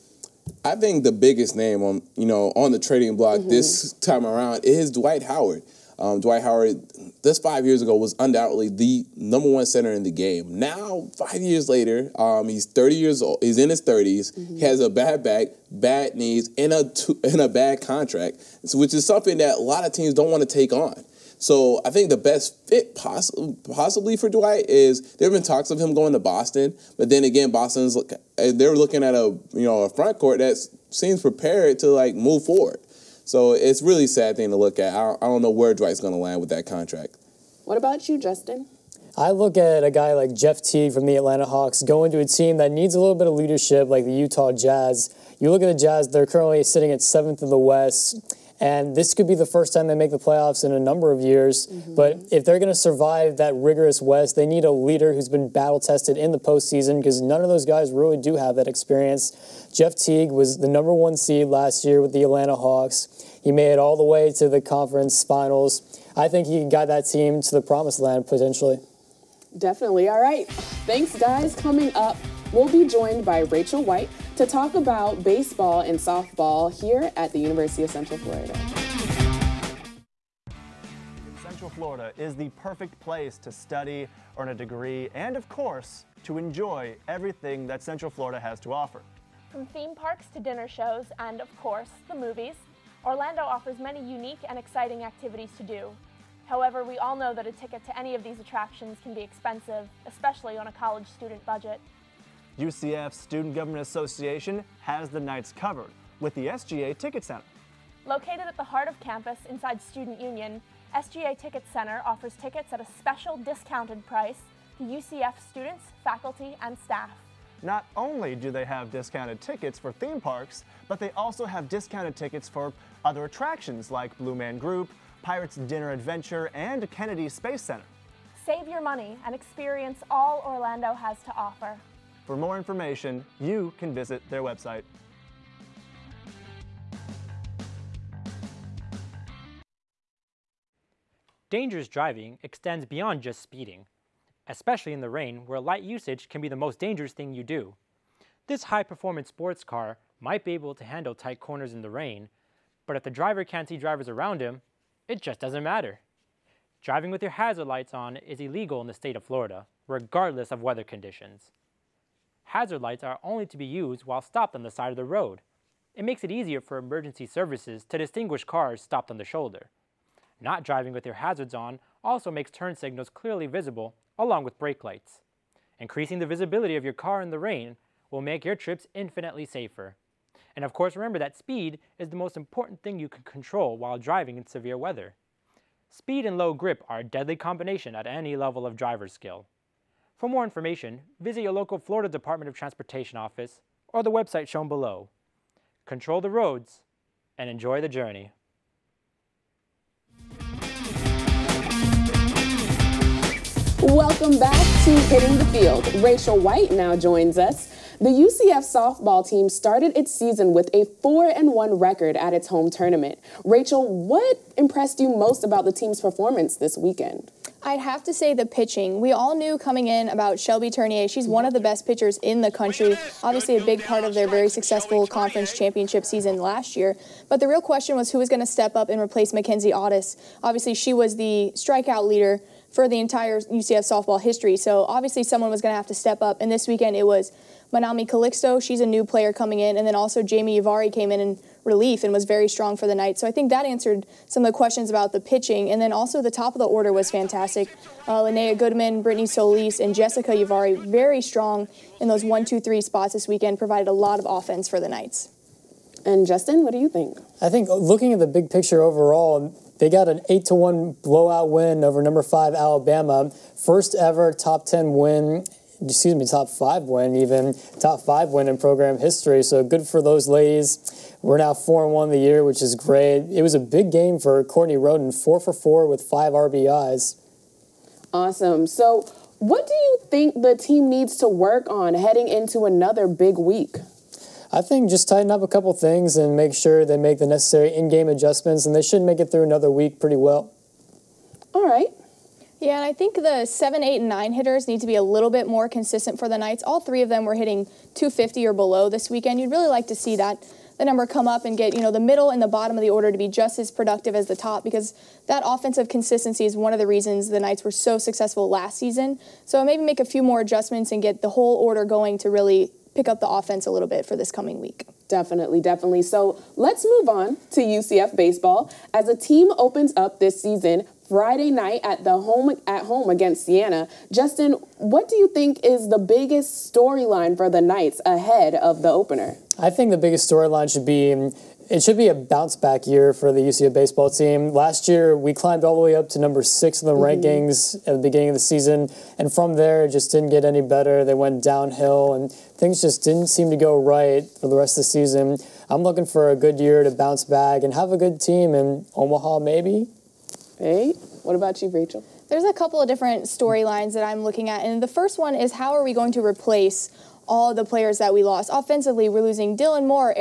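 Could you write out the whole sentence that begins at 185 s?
Speed and low grip are a deadly combination at any level of driver skill.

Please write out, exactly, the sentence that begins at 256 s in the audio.
And Justin, what do you think?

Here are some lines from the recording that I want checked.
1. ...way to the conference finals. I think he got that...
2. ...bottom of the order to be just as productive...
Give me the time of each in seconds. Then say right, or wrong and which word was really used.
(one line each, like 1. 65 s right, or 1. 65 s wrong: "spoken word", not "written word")
1. 64 s right
2. 302 s right.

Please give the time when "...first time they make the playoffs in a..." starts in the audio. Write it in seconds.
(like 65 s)
49 s.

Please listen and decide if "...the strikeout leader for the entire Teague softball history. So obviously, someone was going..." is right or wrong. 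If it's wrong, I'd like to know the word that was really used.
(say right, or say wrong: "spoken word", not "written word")
wrong: "UCF", not "Teague".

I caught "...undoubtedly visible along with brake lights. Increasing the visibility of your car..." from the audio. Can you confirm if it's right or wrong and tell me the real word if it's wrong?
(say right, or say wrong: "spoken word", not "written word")
wrong: "clearly", not "undoubtedly".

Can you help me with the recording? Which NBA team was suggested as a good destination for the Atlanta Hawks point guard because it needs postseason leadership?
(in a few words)
Utah Jazz.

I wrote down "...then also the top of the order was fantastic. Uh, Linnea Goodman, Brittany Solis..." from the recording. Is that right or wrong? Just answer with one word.
right.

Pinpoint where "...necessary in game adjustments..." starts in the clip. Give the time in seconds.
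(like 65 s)
287 s.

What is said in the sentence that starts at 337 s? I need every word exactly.
rankings at the beginning of the season, and from there, it just didn't get any better.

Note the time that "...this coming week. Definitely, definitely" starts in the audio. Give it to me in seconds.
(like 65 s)
314 s.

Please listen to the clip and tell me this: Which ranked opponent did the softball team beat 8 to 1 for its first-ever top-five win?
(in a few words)
Alabama.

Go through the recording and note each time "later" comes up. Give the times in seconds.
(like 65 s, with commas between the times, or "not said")
11 s.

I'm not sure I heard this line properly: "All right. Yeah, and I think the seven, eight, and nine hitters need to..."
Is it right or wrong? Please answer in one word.
right.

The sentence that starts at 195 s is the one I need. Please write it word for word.
Control the roads and enjoy the journey.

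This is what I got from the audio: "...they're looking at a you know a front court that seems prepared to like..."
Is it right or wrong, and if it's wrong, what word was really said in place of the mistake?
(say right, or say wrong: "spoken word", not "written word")
right.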